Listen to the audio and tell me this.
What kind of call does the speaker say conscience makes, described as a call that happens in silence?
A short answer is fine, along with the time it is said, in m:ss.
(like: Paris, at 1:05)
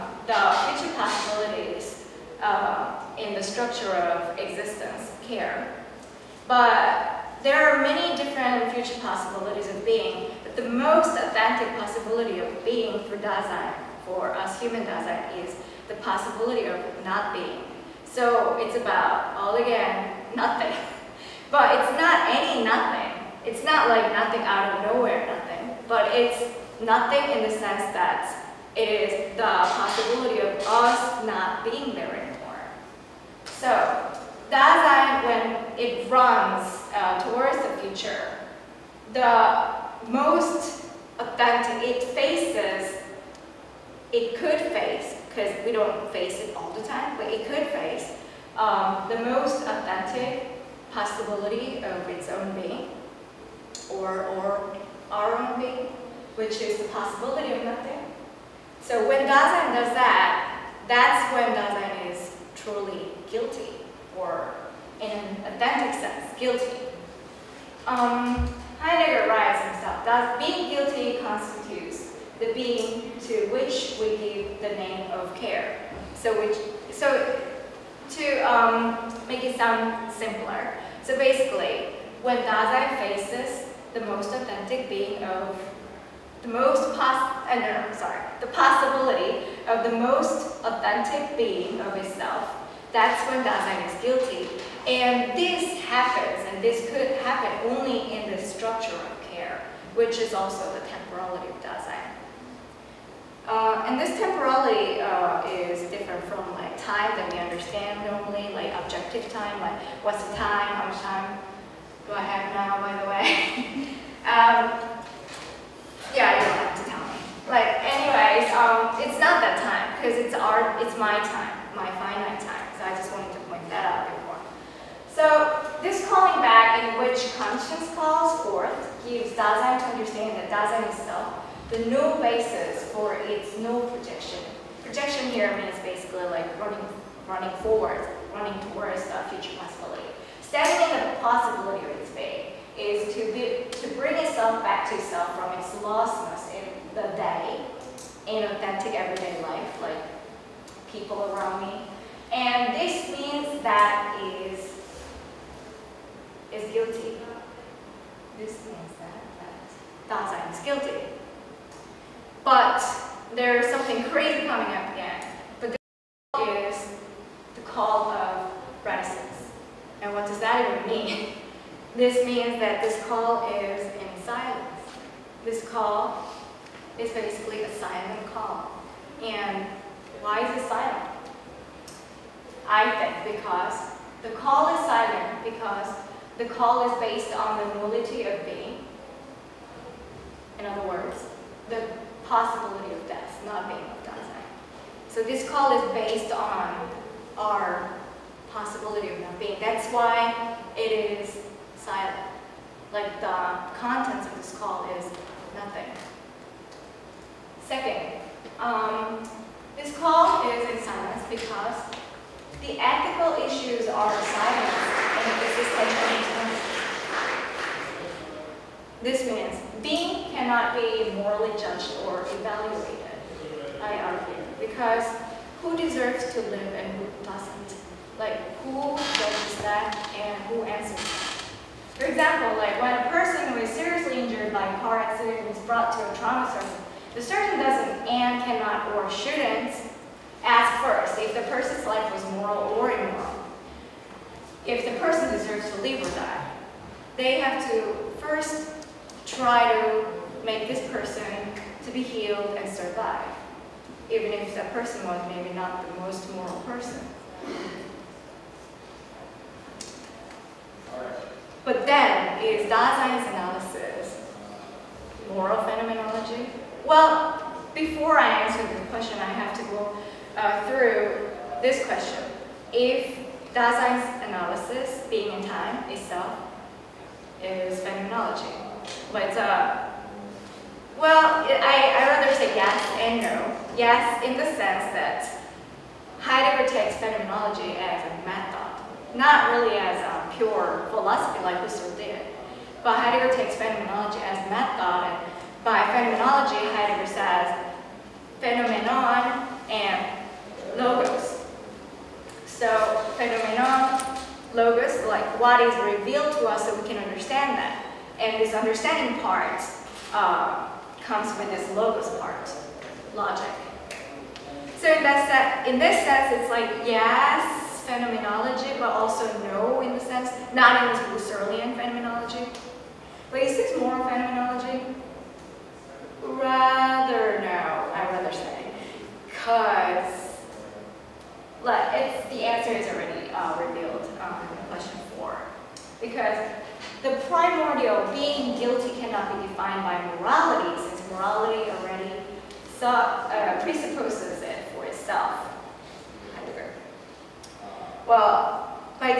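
the call of reticence, at 2:47.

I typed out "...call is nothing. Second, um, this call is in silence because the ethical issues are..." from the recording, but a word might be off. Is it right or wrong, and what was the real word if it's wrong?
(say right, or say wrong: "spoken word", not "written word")
right.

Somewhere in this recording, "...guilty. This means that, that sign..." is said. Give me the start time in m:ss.
2:36.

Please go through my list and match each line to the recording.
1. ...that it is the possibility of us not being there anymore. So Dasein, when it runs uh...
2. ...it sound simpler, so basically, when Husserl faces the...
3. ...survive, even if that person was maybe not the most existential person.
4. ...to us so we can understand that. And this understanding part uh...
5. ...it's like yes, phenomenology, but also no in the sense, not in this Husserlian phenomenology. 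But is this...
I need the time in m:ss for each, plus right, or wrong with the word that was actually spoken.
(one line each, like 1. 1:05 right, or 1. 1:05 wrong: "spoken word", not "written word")
1. 0:27 right
2. 1:19 wrong: "Dasein", not "Husserl"
3. 4:12 wrong: "moral", not "existential"
4. 5:06 right
5. 5:16 right.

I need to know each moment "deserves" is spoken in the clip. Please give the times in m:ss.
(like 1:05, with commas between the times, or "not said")
3:45, 4:05.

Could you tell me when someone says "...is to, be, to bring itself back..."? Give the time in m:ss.
2:22.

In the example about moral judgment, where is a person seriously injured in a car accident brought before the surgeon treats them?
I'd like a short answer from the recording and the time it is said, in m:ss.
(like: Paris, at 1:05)
a trauma center, at 3:56.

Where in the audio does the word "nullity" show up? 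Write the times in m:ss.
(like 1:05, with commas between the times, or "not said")
3:07.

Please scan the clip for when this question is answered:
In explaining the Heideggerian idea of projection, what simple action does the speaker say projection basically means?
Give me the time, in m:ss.
2:17.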